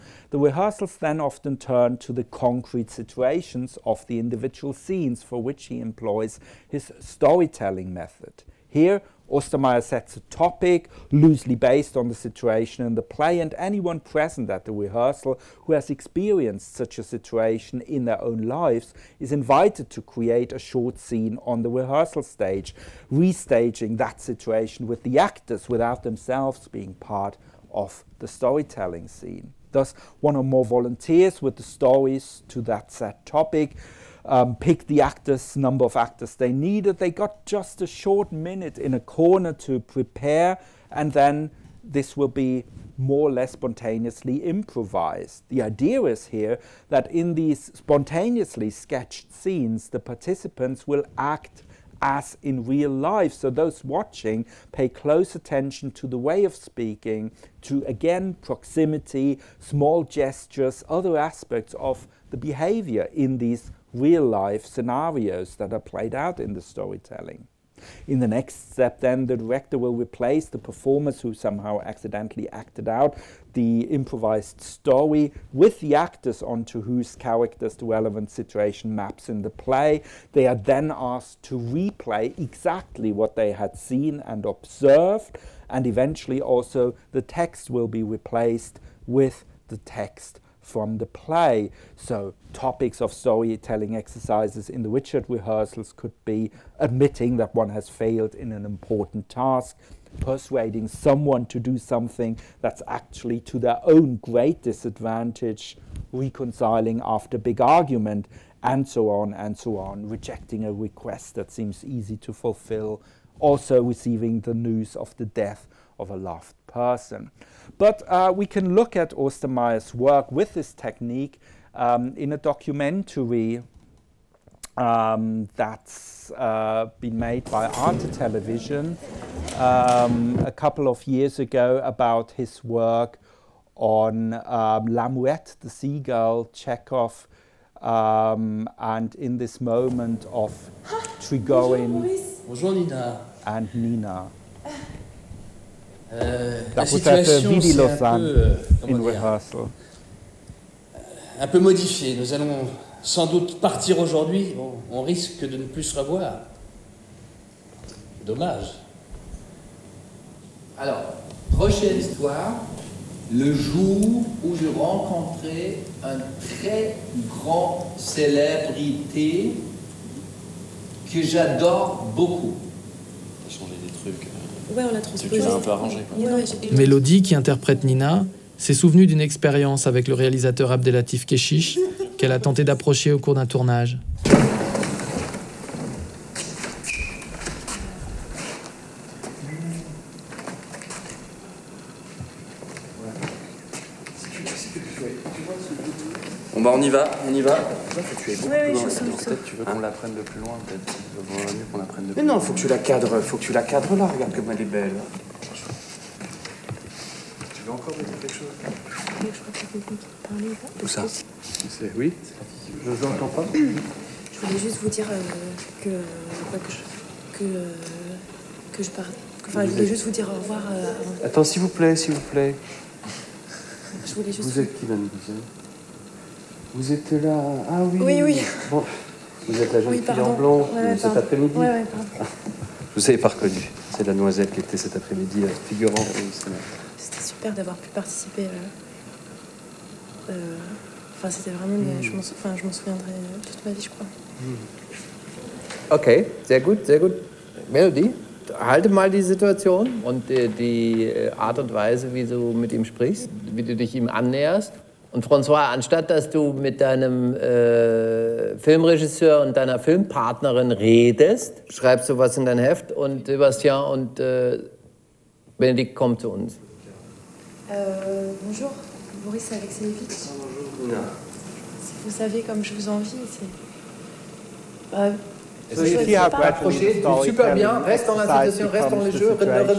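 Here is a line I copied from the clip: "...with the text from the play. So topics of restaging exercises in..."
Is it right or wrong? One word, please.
wrong.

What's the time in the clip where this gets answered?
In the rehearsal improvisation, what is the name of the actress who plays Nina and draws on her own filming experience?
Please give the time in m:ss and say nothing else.
2:56.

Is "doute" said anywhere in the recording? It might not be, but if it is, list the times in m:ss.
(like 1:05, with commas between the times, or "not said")
2:33.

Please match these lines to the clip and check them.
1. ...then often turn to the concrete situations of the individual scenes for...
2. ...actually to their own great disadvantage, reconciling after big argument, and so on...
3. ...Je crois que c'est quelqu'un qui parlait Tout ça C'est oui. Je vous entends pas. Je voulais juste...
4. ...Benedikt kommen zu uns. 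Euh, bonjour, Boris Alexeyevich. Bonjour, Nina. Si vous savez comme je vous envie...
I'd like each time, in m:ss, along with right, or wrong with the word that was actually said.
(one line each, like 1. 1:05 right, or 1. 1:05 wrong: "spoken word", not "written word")
1. 0:00 right
2. 1:42 right
3. 3:28 right
4. 4:25 right.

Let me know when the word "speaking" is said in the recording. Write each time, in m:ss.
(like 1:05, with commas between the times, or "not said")
0:56.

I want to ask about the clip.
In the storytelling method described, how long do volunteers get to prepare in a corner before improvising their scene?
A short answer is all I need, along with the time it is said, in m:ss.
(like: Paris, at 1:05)
a short minute, at 0:37.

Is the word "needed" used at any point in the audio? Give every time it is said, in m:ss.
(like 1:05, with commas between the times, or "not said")
0:36.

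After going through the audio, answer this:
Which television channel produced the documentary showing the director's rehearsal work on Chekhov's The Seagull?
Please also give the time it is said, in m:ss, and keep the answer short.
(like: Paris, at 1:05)
Arte, at 2:07.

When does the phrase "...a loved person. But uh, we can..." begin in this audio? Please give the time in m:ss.
1:56.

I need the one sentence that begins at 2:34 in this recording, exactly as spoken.
on risque de ne plus se revoir.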